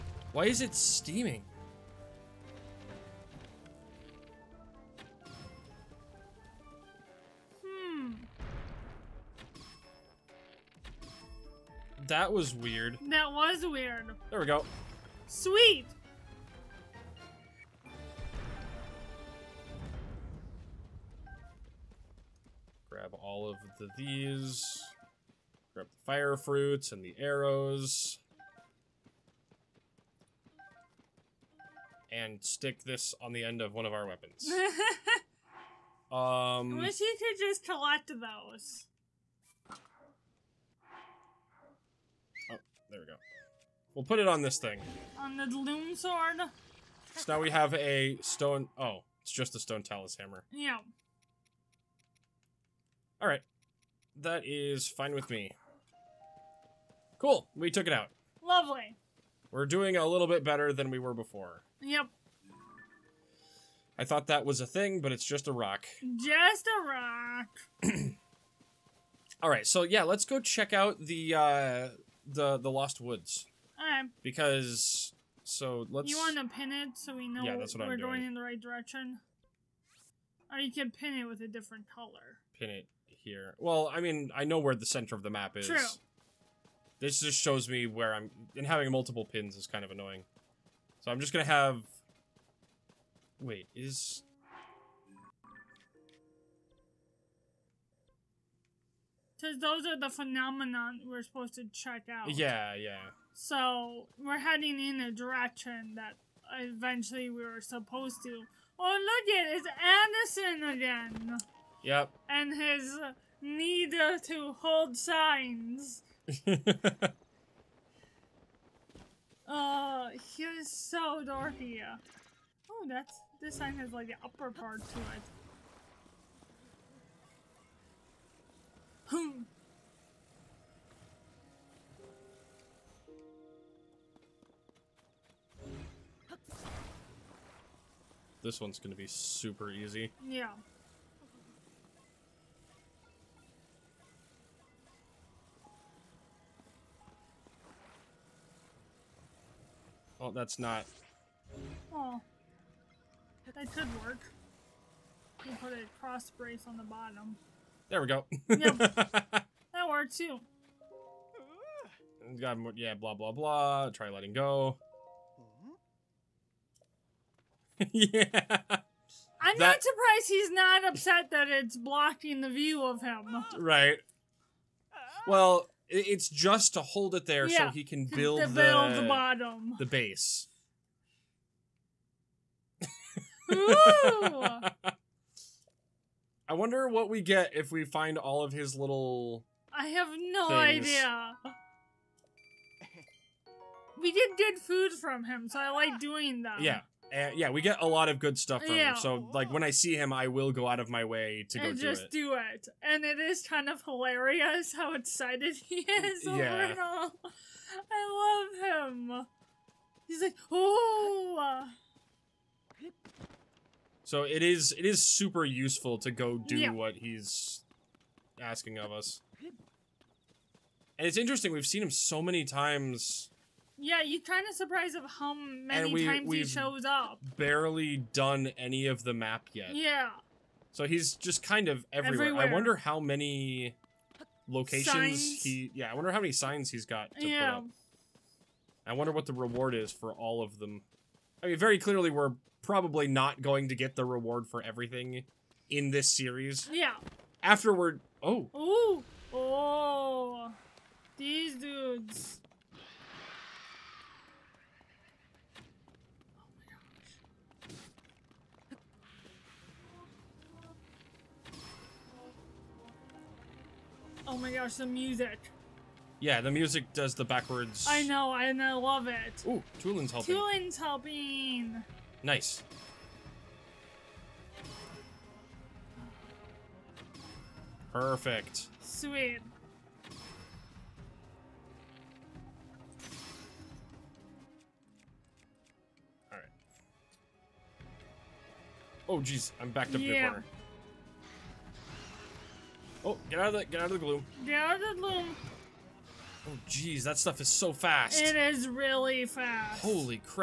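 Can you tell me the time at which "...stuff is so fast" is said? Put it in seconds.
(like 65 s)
297 s.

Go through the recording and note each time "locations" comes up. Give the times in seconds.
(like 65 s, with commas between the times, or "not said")
234 s.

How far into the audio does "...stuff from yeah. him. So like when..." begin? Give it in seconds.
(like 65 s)
198 s.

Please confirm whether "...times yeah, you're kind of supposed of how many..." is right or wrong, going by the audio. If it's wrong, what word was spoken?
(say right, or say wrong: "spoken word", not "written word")
wrong: "surprised", not "supposed".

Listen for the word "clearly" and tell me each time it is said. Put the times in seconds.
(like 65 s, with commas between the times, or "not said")
241 s.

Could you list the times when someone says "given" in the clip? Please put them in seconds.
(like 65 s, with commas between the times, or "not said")
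not said.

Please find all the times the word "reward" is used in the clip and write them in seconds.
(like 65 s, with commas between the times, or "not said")
239 s, 244 s.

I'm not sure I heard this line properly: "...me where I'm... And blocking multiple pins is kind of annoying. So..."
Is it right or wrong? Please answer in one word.
wrong.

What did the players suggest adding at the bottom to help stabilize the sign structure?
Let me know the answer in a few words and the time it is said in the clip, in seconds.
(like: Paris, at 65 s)
A cross brace, at 156 s.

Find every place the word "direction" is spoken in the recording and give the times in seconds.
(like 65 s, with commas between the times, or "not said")
78 s, 105 s.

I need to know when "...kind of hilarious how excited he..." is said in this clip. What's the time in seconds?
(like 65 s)
203 s.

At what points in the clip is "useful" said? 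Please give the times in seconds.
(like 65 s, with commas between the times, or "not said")
215 s.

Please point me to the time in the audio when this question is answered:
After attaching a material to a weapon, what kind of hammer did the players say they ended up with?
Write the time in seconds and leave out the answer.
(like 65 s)
49 s.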